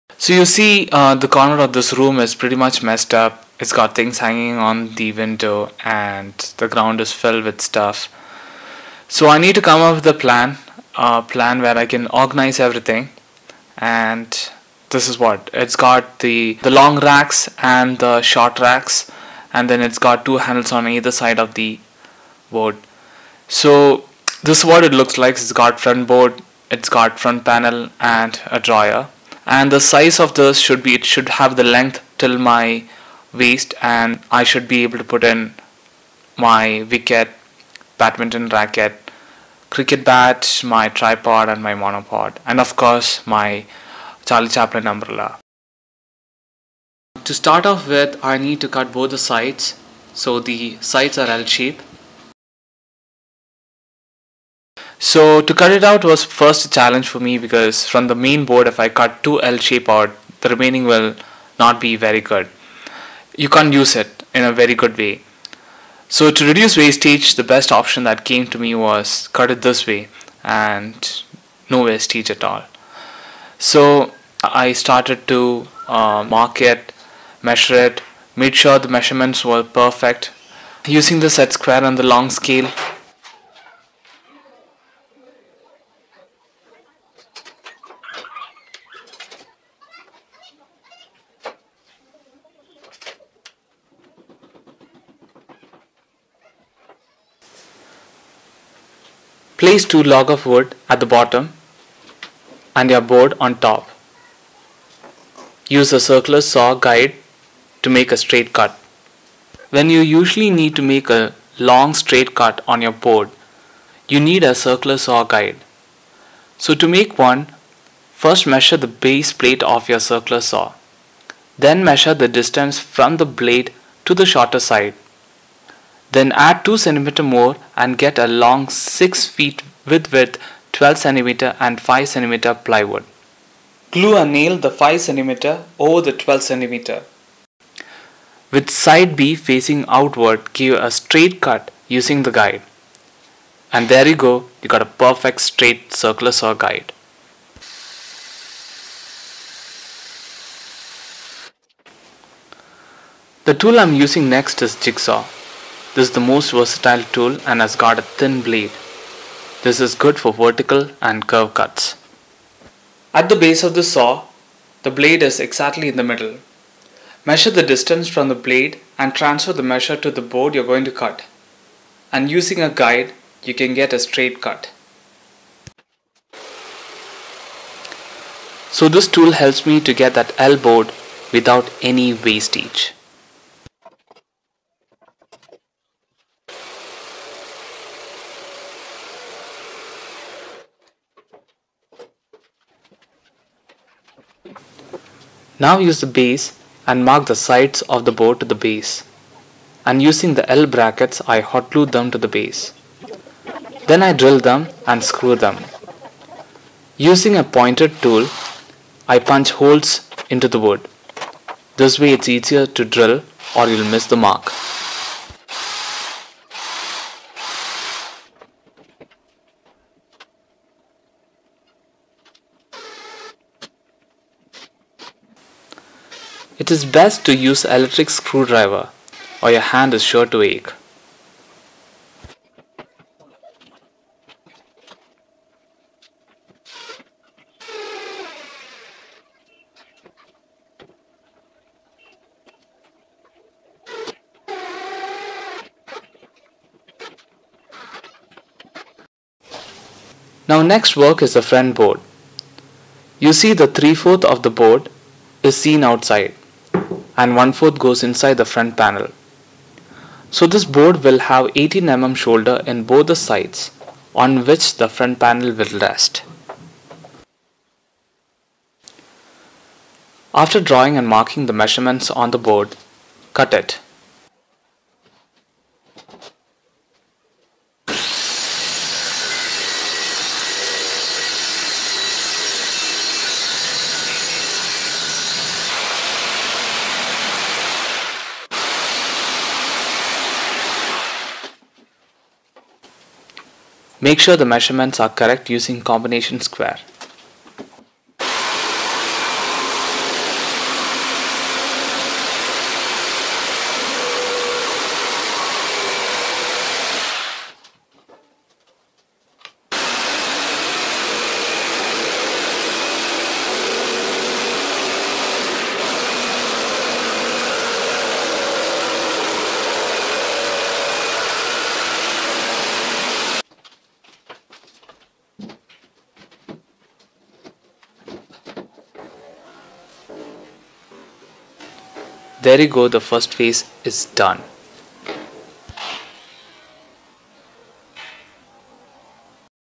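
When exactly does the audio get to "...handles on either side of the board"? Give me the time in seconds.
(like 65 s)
20 s.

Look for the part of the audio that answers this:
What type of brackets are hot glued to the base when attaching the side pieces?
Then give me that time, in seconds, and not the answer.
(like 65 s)
200 s.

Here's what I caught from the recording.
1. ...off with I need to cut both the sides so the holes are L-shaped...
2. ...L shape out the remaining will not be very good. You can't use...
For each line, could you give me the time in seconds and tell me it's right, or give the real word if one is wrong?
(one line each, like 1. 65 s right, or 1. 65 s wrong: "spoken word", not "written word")
1. 47 s wrong: "sides", not "holes"
2. 59 s right.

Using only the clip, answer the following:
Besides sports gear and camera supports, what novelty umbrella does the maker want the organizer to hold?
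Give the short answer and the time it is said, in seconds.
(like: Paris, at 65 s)
Charlie Chaplin umbrella, at 44 s.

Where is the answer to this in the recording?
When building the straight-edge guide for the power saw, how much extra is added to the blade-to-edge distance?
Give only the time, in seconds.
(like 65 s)
126 s.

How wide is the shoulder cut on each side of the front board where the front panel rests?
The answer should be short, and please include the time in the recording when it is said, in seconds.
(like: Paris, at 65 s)
18 mm, at 261 s.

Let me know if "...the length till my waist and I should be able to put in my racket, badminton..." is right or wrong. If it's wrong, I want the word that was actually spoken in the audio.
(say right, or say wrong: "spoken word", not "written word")
wrong: "wicket", not "racket".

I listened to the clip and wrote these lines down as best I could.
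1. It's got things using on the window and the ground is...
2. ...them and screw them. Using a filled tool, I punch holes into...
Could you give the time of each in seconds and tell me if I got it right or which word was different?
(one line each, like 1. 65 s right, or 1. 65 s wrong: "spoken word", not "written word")
1. 3 s wrong: "hanging", not "using"
2. 204 s wrong: "pointed", not "filled".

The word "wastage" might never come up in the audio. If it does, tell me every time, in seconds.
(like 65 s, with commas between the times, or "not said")
66 s, 71 s, 182 s.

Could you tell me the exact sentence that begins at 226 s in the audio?
It is best to use electric screwdriver or your hand is sure to ache.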